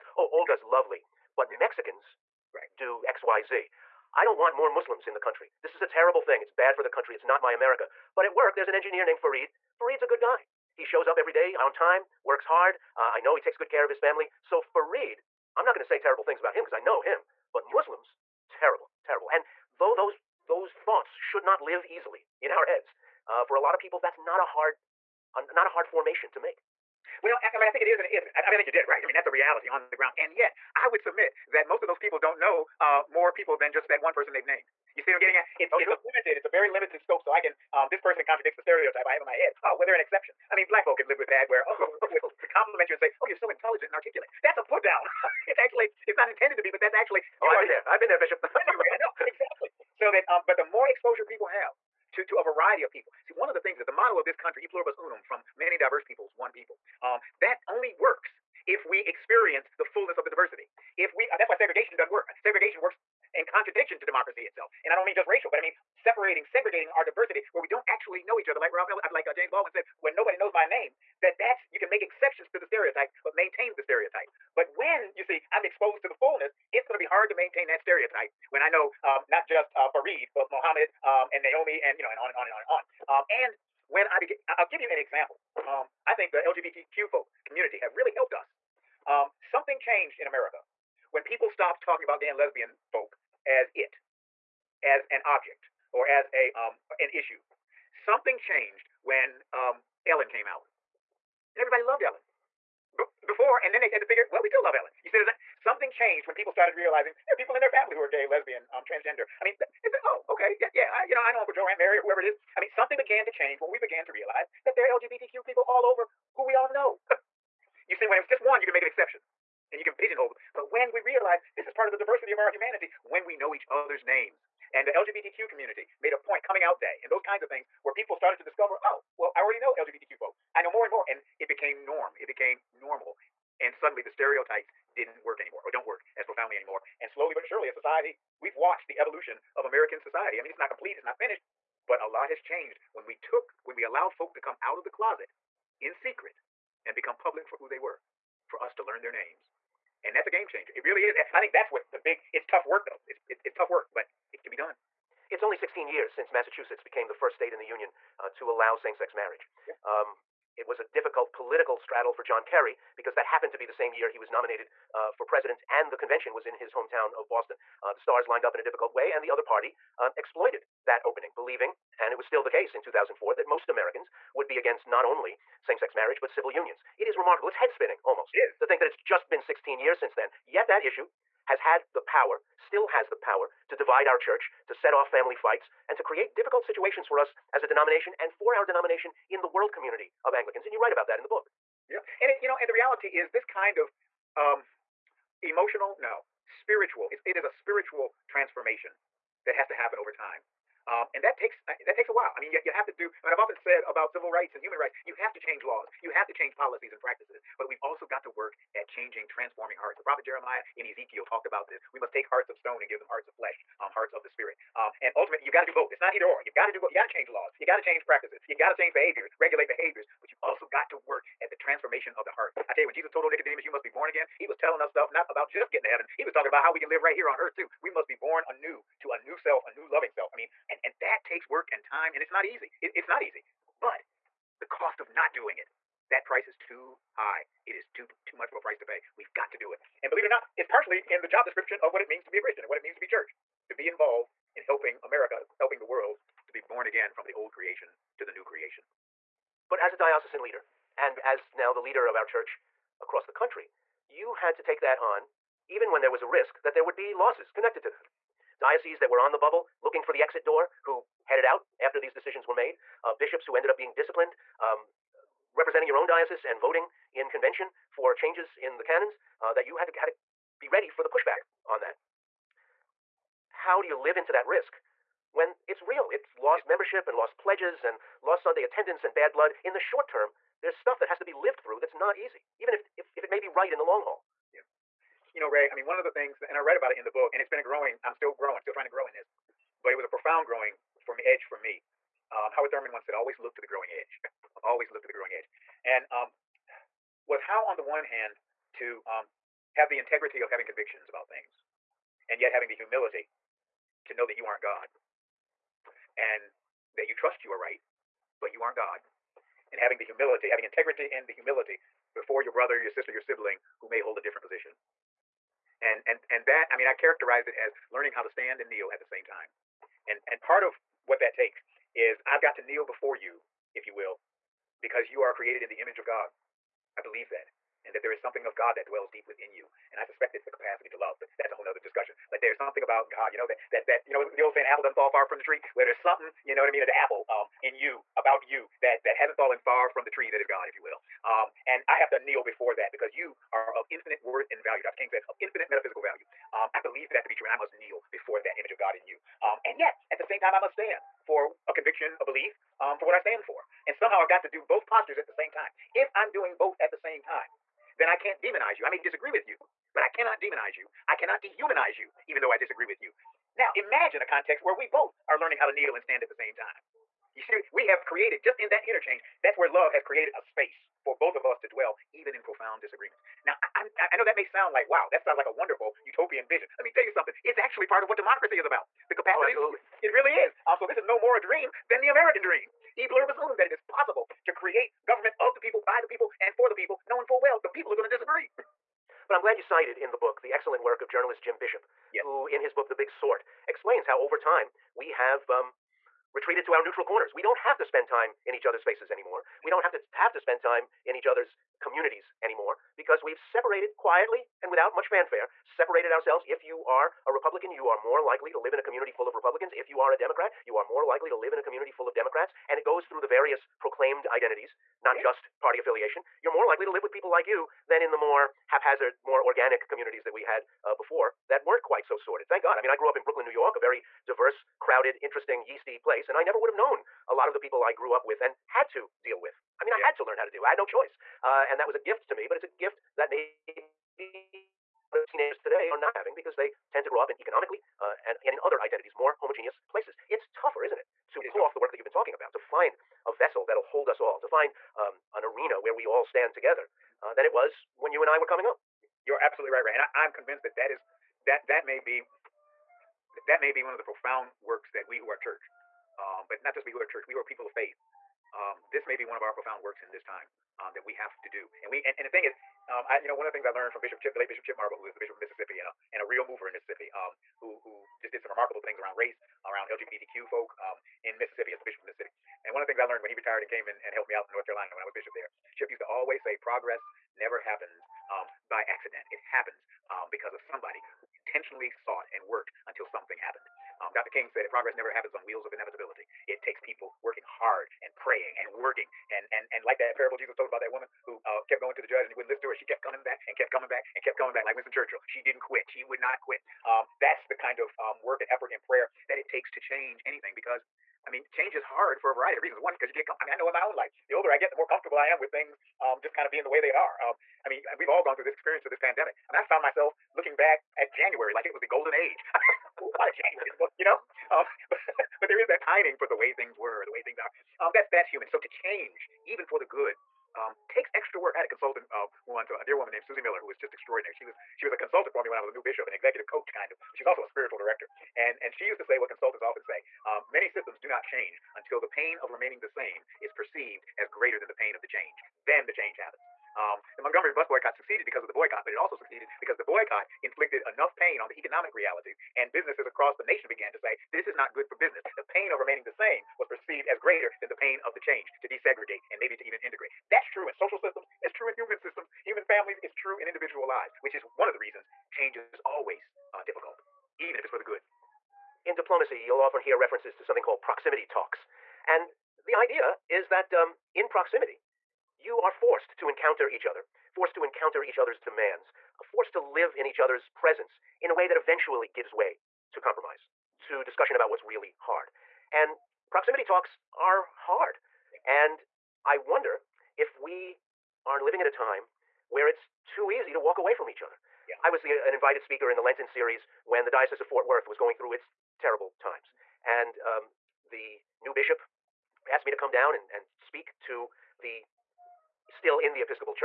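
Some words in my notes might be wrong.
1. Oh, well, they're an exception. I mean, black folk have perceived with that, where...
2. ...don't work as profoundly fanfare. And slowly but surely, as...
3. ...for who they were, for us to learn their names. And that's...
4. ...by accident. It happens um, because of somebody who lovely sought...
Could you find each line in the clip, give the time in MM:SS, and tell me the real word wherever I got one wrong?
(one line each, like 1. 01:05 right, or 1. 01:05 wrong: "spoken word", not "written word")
1. 00:39 wrong: "lived", not "perceived"
2. 02:15 wrong: "anymore", not "fanfare"
3. 02:27 right
4. 07:58 wrong: "intentionally", not "lovely".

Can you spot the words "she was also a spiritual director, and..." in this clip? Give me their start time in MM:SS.
08:47.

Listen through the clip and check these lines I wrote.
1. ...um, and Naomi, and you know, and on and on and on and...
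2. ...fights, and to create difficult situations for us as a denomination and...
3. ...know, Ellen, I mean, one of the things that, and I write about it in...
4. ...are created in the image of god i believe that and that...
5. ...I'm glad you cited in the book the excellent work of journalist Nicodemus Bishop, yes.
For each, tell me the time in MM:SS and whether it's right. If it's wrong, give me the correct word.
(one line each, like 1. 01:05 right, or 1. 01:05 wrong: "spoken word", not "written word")
1. 01:21 right
2. 03:05 right
3. 04:45 wrong: "Ray", not "Ellen"
4. 05:25 right
5. 06:29 wrong: "Jim", not "Nicodemus".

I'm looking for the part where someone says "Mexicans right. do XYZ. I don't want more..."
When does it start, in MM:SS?
00:01.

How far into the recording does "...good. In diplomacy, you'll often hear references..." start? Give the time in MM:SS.
09:17.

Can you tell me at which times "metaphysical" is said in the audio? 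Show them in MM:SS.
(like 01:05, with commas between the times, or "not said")
05:45.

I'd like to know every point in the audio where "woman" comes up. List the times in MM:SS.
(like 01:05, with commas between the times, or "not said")
08:10, 08:42.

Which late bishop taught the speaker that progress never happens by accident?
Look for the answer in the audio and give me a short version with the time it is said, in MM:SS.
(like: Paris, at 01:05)
Chip Marble, at 07:44.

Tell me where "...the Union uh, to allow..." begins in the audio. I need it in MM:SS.
02:37.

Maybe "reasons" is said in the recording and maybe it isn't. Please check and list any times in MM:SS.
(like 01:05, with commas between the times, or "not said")
08:22, 09:14.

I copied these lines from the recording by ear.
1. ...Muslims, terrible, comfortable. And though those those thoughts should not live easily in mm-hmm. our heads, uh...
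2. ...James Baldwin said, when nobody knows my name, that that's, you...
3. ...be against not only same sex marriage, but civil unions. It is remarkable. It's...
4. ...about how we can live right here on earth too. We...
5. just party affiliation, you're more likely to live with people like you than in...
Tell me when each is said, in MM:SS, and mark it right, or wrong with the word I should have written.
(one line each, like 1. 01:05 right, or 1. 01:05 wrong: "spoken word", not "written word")
1. 00:17 wrong: "terrible", not "comfortable"
2. 01:09 right
3. 02:54 right
4. 03:46 right
5. 06:55 right.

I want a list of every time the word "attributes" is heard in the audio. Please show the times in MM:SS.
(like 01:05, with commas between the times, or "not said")
not said.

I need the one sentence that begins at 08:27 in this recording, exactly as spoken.
Um, I mean, and we've all gone through this experience of this pandemic.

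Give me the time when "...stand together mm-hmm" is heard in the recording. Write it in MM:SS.
07:26.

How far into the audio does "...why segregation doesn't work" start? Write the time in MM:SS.
01:01.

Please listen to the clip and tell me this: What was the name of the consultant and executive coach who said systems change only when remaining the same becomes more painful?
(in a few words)
Susie Miller.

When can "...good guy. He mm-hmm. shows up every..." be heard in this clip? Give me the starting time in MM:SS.
00:10.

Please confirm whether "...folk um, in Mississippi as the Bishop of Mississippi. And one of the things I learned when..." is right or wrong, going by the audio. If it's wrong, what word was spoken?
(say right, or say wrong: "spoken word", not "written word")
right.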